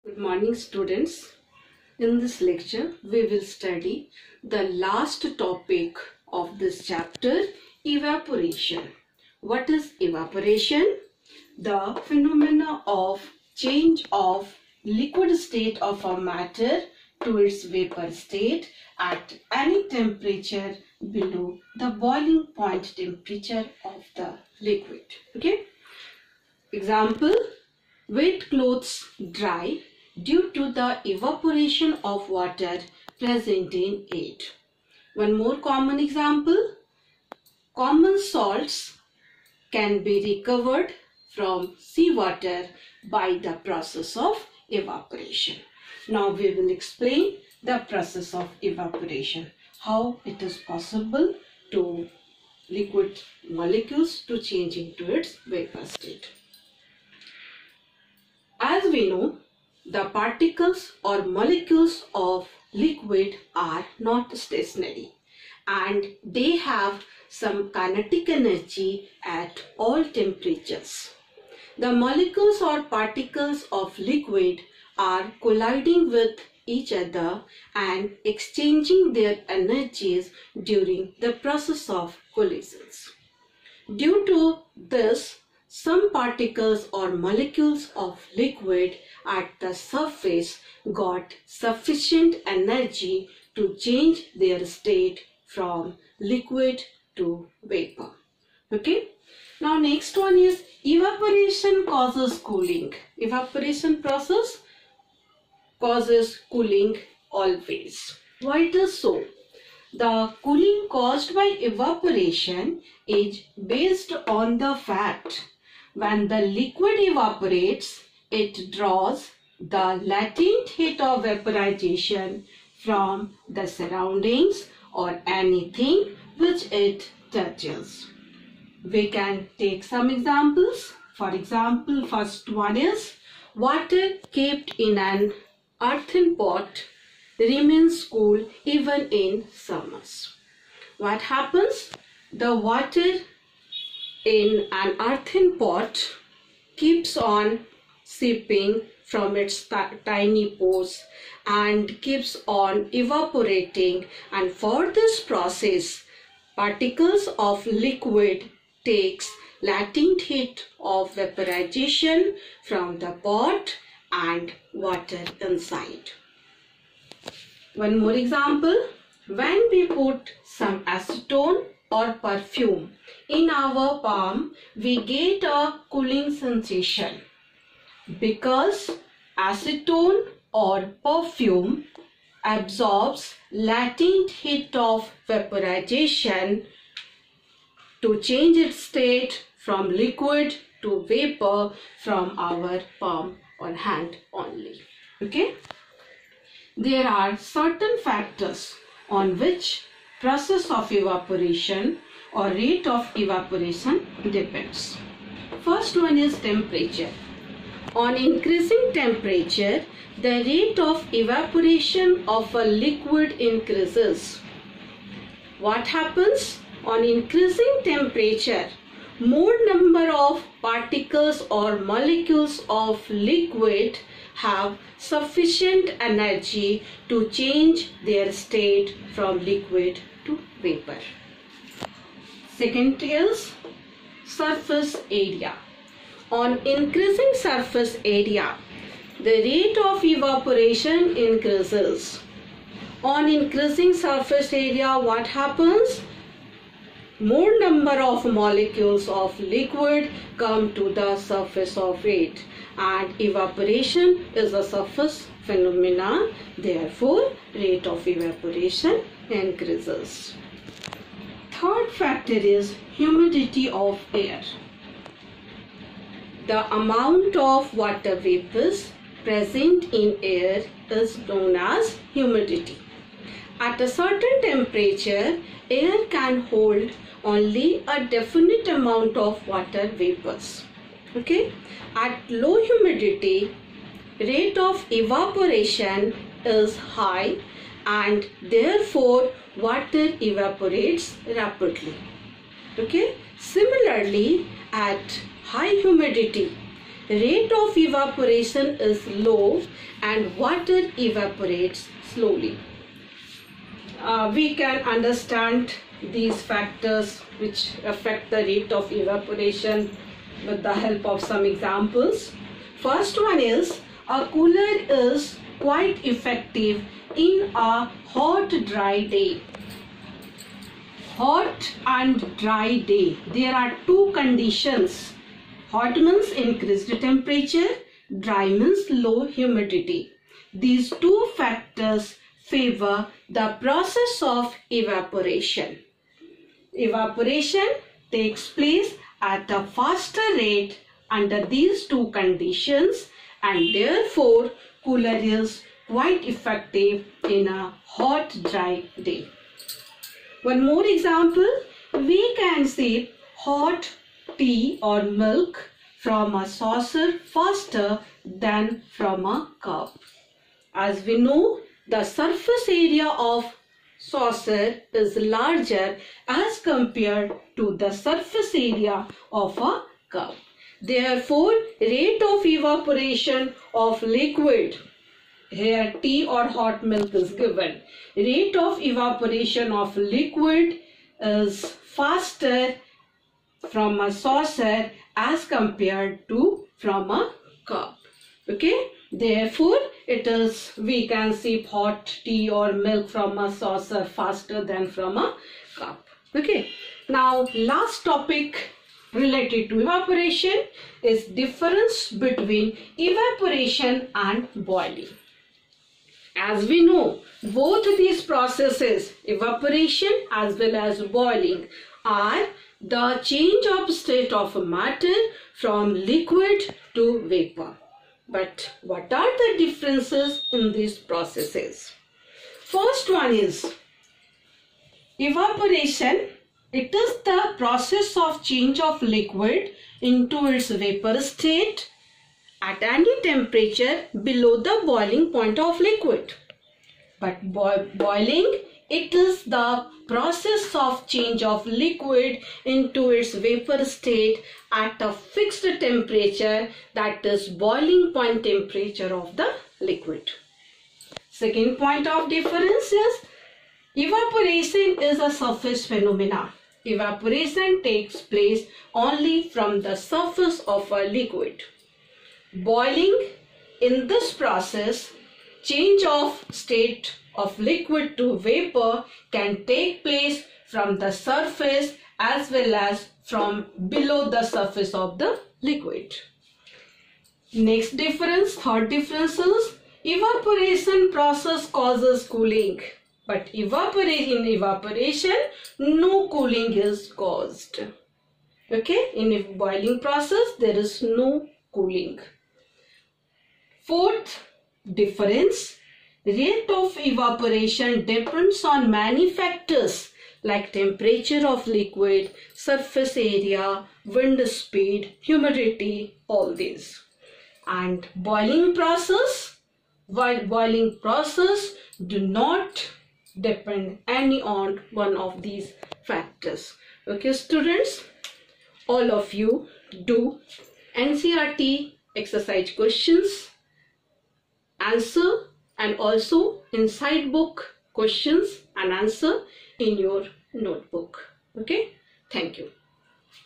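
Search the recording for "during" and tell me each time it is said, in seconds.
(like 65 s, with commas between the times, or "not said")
80 s.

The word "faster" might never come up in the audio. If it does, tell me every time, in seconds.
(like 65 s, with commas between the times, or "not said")
339 s, 357 s, 381 s, 394 s.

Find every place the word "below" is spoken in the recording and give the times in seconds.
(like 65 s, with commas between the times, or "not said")
21 s, 434 s, 473 s.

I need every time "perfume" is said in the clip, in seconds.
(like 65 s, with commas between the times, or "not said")
172 s, 181 s.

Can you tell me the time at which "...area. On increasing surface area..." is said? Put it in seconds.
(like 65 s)
235 s.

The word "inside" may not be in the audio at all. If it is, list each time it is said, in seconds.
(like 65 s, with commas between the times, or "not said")
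165 s, 526 s.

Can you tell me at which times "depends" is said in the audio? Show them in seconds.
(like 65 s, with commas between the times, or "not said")
204 s, 498 s, 513 s.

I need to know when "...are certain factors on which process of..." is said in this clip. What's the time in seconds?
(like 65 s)
197 s.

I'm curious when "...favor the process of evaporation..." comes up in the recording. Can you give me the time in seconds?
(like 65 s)
332 s.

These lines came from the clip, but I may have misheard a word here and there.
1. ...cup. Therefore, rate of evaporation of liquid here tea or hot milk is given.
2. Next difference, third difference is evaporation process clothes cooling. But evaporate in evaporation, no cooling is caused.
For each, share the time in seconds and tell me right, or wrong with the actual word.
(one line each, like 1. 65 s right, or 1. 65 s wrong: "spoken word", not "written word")
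1. 370 s right
2. 477 s wrong: "causes", not "clothes".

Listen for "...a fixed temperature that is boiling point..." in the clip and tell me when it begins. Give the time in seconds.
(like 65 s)
445 s.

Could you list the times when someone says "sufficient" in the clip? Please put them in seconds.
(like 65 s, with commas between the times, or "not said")
91 s, 224 s.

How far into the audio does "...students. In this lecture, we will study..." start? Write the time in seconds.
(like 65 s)
0 s.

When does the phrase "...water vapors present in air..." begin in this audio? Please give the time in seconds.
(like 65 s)
267 s.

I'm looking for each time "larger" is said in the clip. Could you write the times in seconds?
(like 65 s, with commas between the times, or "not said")
365 s.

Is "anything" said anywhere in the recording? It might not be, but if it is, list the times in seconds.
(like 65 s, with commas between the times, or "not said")
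125 s.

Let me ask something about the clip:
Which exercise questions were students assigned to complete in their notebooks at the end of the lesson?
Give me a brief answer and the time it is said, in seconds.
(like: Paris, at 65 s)
NCERT, at 520 s.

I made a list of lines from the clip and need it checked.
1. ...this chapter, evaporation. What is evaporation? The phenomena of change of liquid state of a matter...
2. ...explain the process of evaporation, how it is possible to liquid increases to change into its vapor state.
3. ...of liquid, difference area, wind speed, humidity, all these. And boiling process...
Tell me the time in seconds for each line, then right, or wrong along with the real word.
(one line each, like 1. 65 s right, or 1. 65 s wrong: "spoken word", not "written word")
1. 6 s right
2. 46 s wrong: "molecules", not "increases"
3. 501 s wrong: "surface", not "difference".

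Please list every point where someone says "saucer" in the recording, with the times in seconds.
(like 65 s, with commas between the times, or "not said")
356 s, 364 s, 384 s, 393 s.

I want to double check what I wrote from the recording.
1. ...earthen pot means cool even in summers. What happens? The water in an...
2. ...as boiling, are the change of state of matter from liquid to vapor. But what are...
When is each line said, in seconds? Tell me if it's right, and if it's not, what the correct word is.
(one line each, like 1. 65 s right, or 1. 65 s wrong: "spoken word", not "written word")
1. 135 s wrong: "remains", not "means"
2. 410 s right.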